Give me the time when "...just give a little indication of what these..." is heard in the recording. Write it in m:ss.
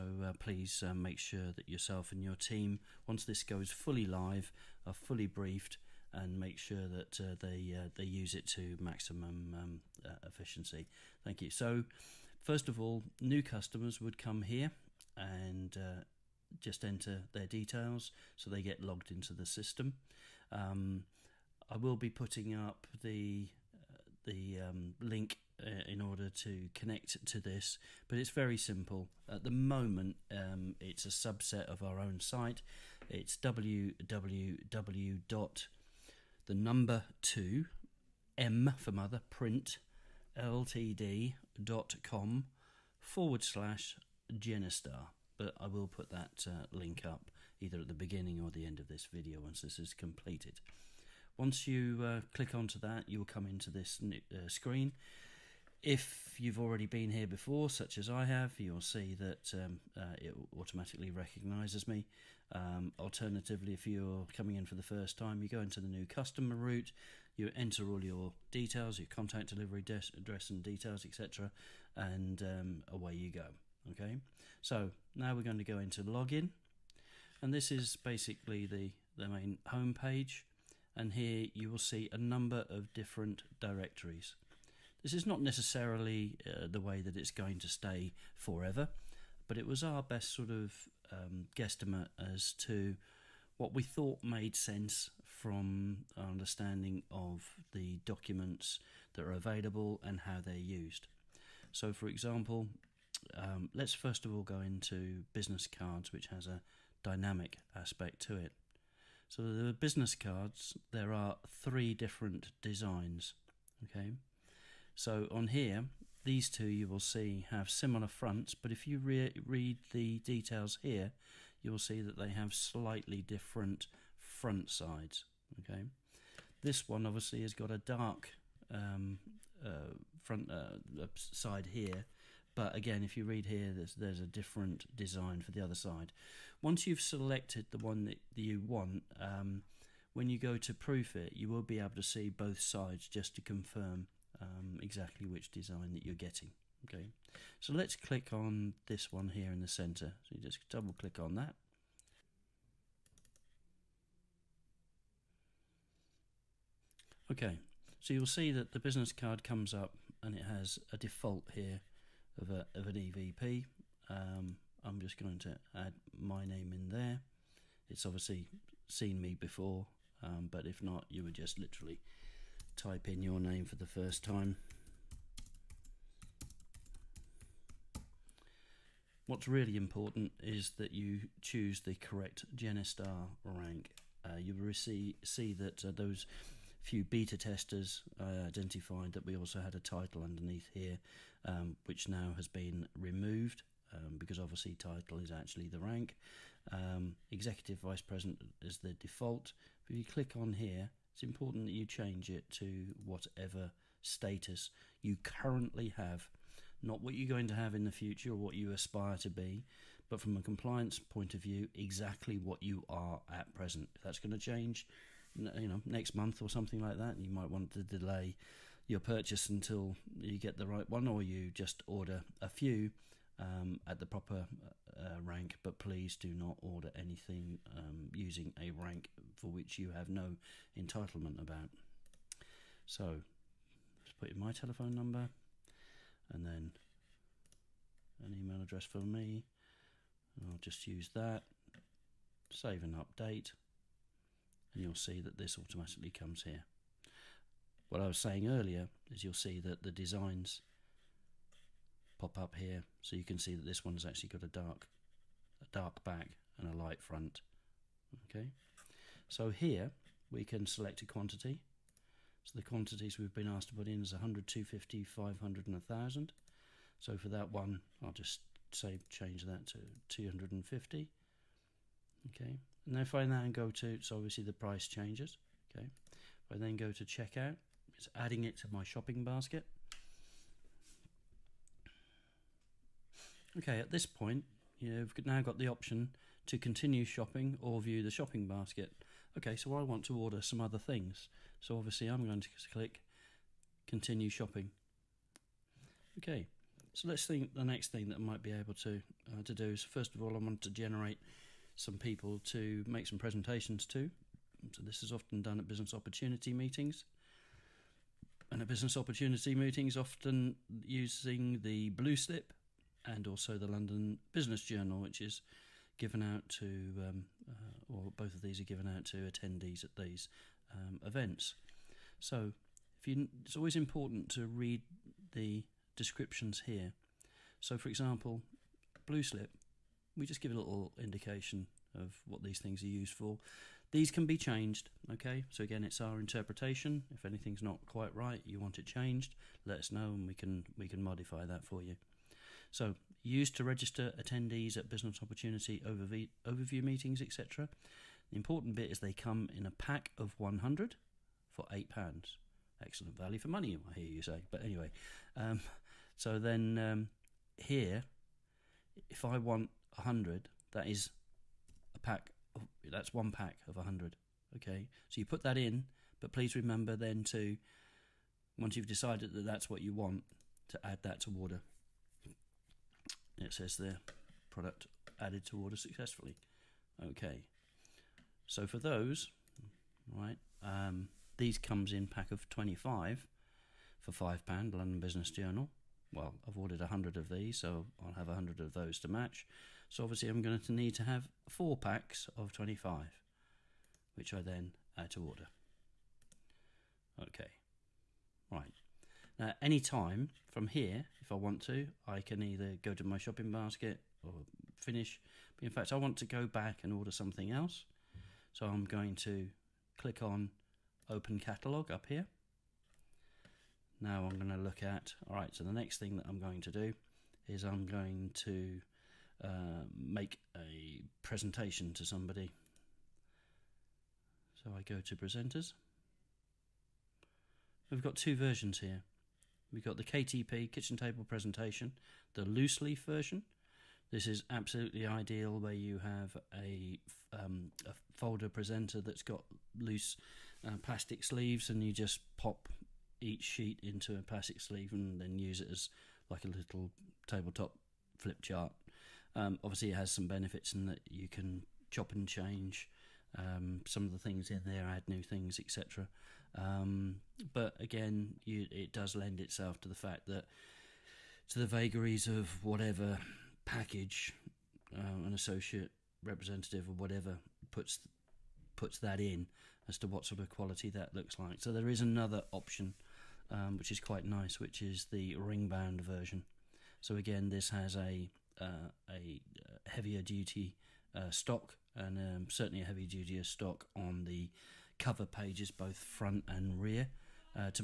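5:30.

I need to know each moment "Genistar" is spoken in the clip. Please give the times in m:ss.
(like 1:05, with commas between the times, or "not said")
0:44, 3:02.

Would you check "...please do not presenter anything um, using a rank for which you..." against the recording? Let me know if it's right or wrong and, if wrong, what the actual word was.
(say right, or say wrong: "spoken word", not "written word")
wrong: "order", not "presenter".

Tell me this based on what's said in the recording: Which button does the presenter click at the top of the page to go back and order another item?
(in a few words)
Open Catalog.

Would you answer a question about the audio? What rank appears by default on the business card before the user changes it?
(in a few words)
Executive vice president.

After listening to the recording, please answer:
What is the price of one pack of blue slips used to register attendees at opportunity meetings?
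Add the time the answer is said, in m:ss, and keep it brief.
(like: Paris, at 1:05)
£8, at 5:51.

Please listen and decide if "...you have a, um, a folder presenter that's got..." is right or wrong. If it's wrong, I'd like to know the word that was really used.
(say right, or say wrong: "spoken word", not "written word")
right.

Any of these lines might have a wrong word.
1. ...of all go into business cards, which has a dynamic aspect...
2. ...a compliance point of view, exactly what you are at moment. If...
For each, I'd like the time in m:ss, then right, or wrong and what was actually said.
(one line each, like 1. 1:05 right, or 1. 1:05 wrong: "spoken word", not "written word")
1. 1:44 right
2. 3:30 wrong: "present", not "moment".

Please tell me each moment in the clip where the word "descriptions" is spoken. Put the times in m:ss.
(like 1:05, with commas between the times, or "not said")
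5:25.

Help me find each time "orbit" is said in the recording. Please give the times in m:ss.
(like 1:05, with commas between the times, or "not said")
not said.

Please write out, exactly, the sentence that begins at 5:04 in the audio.
So this is often done at business opportunity meetings.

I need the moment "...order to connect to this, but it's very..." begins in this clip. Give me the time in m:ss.
0:25.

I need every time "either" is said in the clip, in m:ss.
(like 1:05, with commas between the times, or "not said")
0:47, 6:42.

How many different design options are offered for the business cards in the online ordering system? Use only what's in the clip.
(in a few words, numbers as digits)
3.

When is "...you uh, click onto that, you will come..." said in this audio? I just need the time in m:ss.
0:51.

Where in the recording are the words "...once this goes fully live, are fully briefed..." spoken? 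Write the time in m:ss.
0:03.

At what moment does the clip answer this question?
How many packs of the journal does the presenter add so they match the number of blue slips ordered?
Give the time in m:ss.
6:31.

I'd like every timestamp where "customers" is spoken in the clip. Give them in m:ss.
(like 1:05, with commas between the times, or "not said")
0:13, 1:06.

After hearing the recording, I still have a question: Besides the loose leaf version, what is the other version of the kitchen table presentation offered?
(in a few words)
Ring bound version.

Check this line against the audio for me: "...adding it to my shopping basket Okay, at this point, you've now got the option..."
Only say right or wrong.
right.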